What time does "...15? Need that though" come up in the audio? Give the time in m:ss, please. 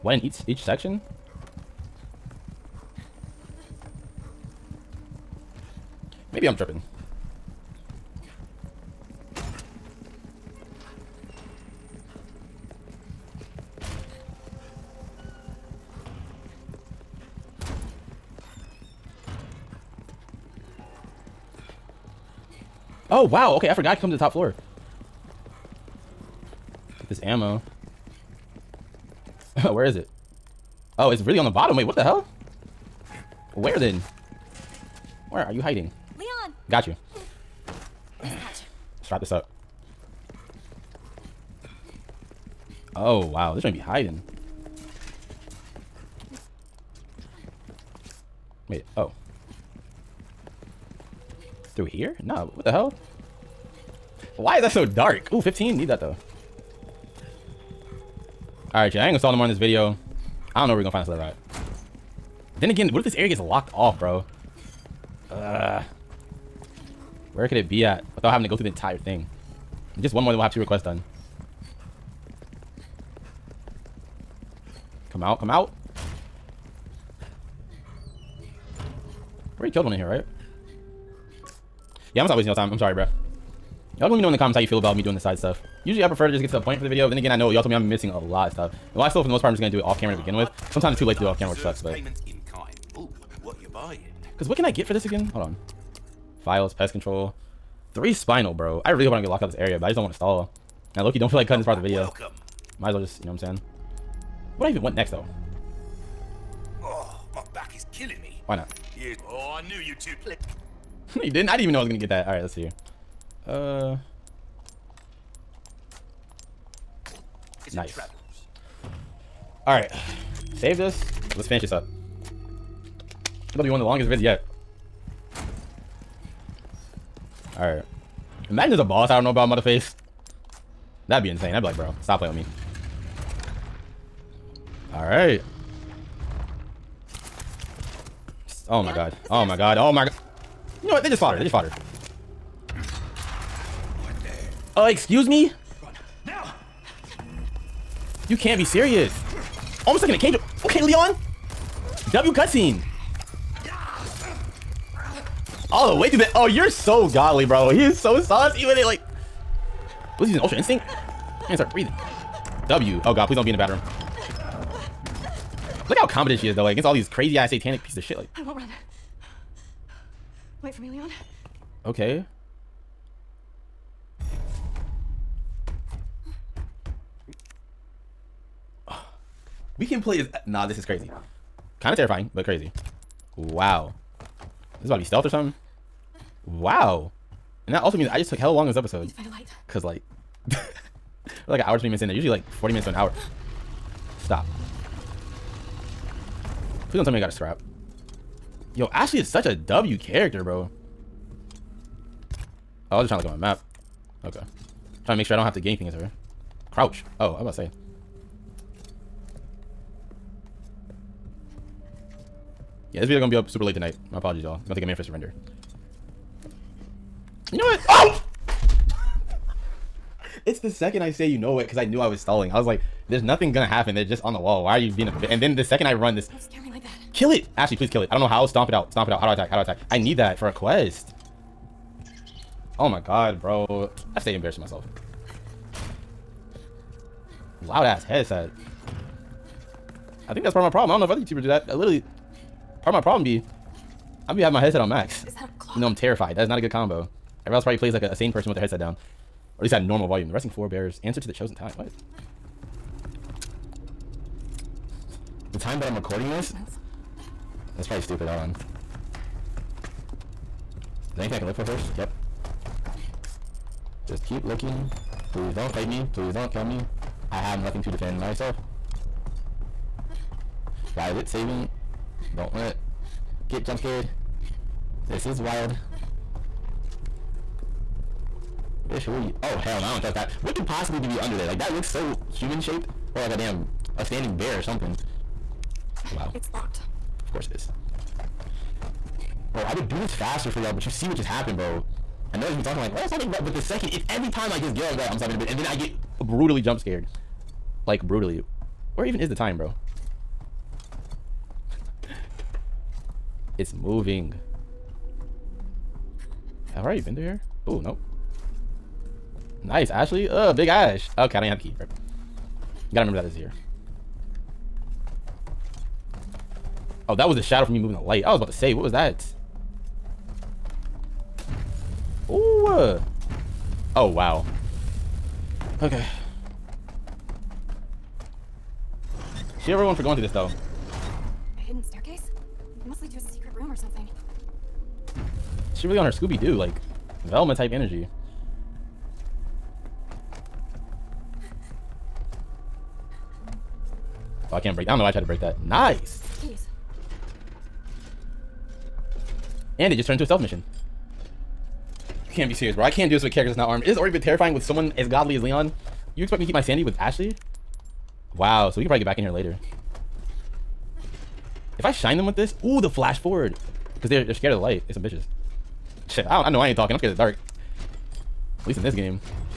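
0:55.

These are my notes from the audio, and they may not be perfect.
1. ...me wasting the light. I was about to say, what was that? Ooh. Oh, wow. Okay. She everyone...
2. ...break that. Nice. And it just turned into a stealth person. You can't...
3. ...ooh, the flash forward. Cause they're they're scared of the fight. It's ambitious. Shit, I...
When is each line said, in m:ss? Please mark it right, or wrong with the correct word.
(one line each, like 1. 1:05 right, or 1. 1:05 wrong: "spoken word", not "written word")
1. 5:17 wrong: "moving", not "wasting"
2. 5:45 wrong: "mission", not "person"
3. 6:02 wrong: "light", not "fight".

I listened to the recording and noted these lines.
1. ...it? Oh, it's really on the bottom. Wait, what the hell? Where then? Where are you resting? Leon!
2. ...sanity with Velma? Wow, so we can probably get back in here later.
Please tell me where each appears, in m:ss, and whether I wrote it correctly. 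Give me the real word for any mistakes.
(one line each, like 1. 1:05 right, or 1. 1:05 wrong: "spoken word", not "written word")
1. 0:29 wrong: "hiding", not "resting"
2. 5:56 wrong: "Ashley", not "Velma".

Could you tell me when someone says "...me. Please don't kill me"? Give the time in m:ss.
4:25.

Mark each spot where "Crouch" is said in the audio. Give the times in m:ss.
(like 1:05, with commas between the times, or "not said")
3:26.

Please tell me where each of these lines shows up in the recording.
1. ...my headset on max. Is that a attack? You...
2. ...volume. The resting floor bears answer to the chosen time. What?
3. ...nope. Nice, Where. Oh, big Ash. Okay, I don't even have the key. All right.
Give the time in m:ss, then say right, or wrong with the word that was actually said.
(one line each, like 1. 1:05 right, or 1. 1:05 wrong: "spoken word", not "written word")
1. 4:04 wrong: "clock", not "attack"
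2. 4:10 right
3. 5:07 wrong: "Ashley", not "Where".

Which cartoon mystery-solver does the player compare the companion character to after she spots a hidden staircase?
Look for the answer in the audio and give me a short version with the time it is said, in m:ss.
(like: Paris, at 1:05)
Velma, at 5:37.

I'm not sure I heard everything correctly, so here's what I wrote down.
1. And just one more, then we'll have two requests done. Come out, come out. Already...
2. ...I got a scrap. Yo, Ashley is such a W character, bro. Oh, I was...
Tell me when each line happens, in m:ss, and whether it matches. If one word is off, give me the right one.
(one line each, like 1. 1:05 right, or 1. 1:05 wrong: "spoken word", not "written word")
1. 1:09 right
2. 3:17 right.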